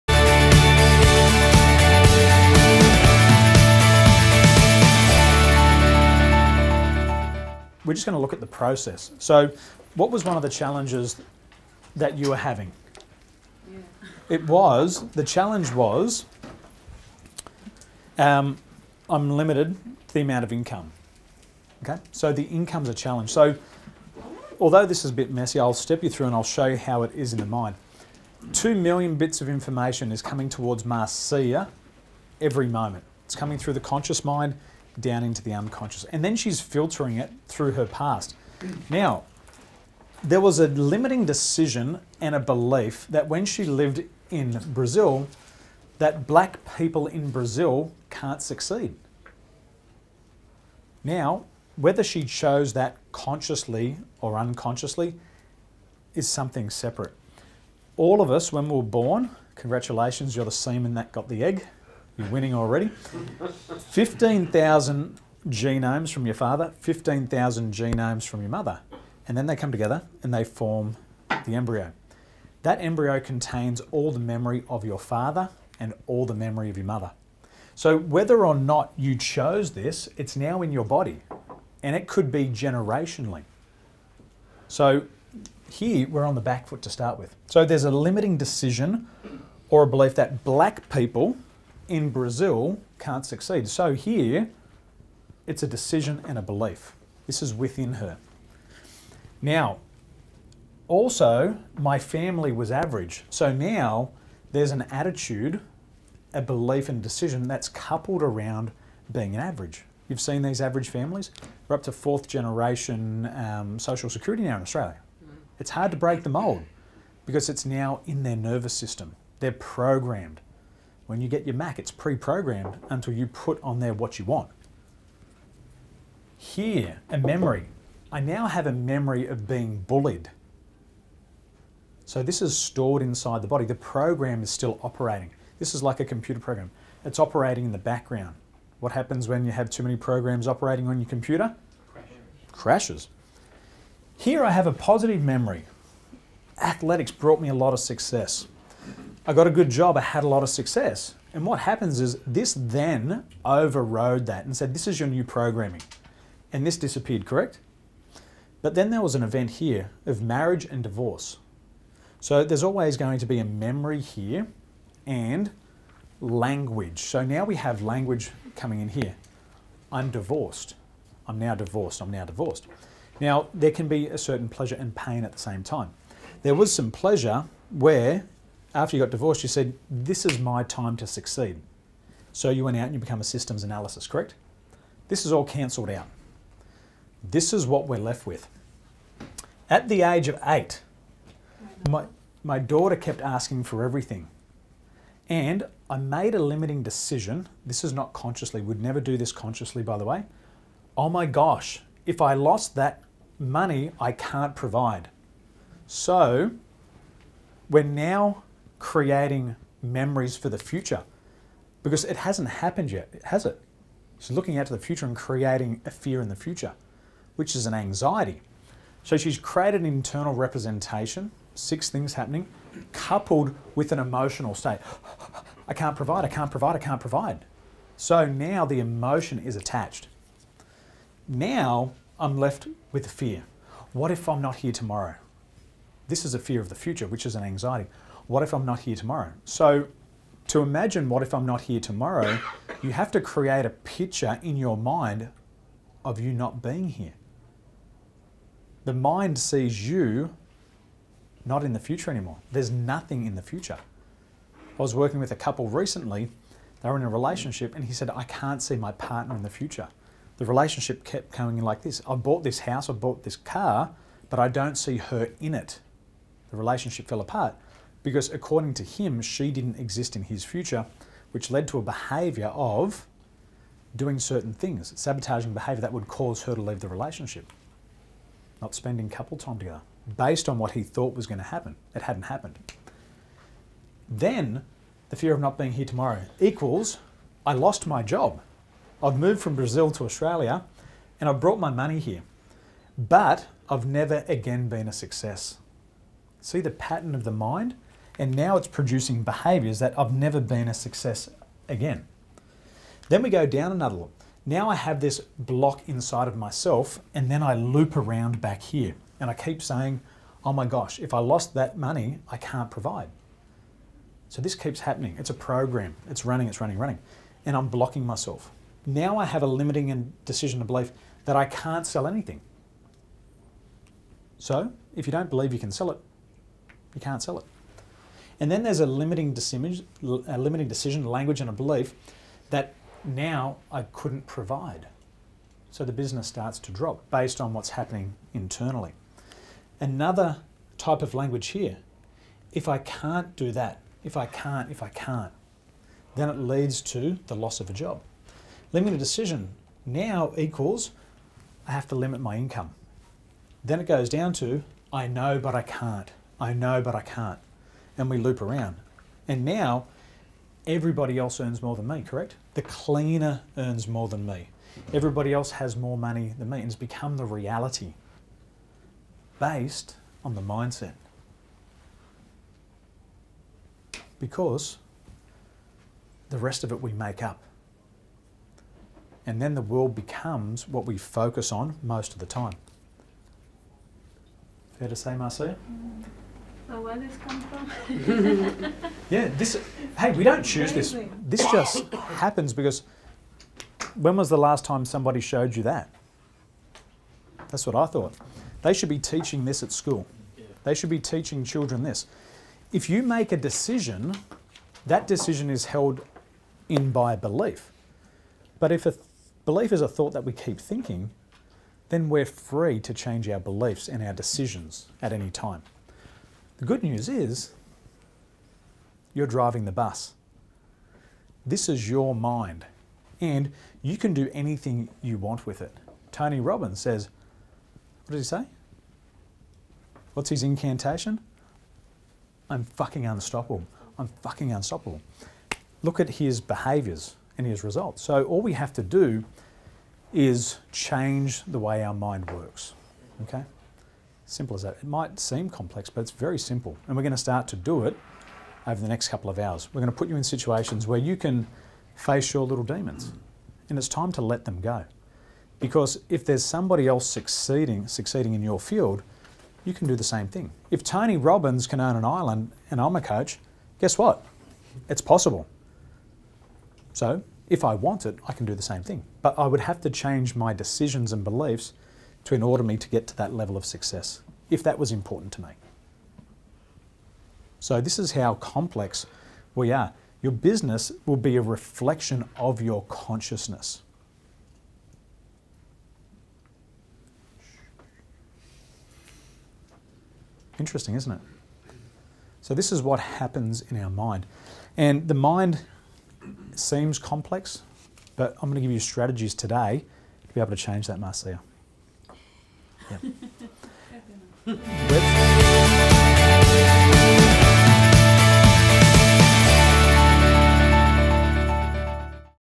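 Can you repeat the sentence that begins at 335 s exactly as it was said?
So the business starts to drop based on what's happening internally.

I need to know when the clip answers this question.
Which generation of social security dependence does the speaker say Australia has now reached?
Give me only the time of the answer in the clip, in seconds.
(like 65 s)
111 s.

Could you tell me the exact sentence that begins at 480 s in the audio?
Your business will be a reflection of your consciousness.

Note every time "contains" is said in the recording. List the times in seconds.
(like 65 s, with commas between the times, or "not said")
73 s.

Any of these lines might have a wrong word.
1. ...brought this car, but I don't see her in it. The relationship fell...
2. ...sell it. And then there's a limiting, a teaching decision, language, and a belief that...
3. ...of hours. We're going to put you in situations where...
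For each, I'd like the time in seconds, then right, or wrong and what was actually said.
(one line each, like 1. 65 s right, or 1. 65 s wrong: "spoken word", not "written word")
1. 262 s wrong: "bought", not "brought"
2. 327 s wrong: "limiting", not "teaching"
3. 449 s right.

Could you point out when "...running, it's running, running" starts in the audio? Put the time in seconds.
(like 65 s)
316 s.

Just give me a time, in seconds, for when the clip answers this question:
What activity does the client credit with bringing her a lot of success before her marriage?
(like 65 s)
146 s.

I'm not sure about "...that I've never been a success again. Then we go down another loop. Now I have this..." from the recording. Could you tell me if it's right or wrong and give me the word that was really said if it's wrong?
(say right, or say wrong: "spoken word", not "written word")
right.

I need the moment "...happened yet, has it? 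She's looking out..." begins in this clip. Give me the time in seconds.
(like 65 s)
212 s.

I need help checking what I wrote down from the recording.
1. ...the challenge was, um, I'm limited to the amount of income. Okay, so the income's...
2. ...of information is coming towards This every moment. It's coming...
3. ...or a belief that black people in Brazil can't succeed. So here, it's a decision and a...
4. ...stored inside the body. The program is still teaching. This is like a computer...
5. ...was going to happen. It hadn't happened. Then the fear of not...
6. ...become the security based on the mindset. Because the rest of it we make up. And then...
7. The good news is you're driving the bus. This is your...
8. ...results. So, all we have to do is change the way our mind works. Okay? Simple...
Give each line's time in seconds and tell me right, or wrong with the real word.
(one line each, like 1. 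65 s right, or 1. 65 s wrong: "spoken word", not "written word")
1. 15 s right
2. 29 s wrong: "Marcia", not "This"
3. 89 s right
4. 132 s wrong: "operating", not "teaching"
5. 281 s right
6. 366 s wrong: "reality", not "security"
7. 416 s right
8. 437 s right.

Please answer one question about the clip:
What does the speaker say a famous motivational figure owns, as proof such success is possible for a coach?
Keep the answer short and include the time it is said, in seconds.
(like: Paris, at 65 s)
An island, at 461 s.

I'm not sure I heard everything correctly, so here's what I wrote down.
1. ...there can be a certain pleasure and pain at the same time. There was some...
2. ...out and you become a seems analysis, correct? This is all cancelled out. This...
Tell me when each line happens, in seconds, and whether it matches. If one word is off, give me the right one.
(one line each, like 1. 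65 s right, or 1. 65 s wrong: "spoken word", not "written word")
1. 173 s right
2. 182 s wrong: "systems", not "seems".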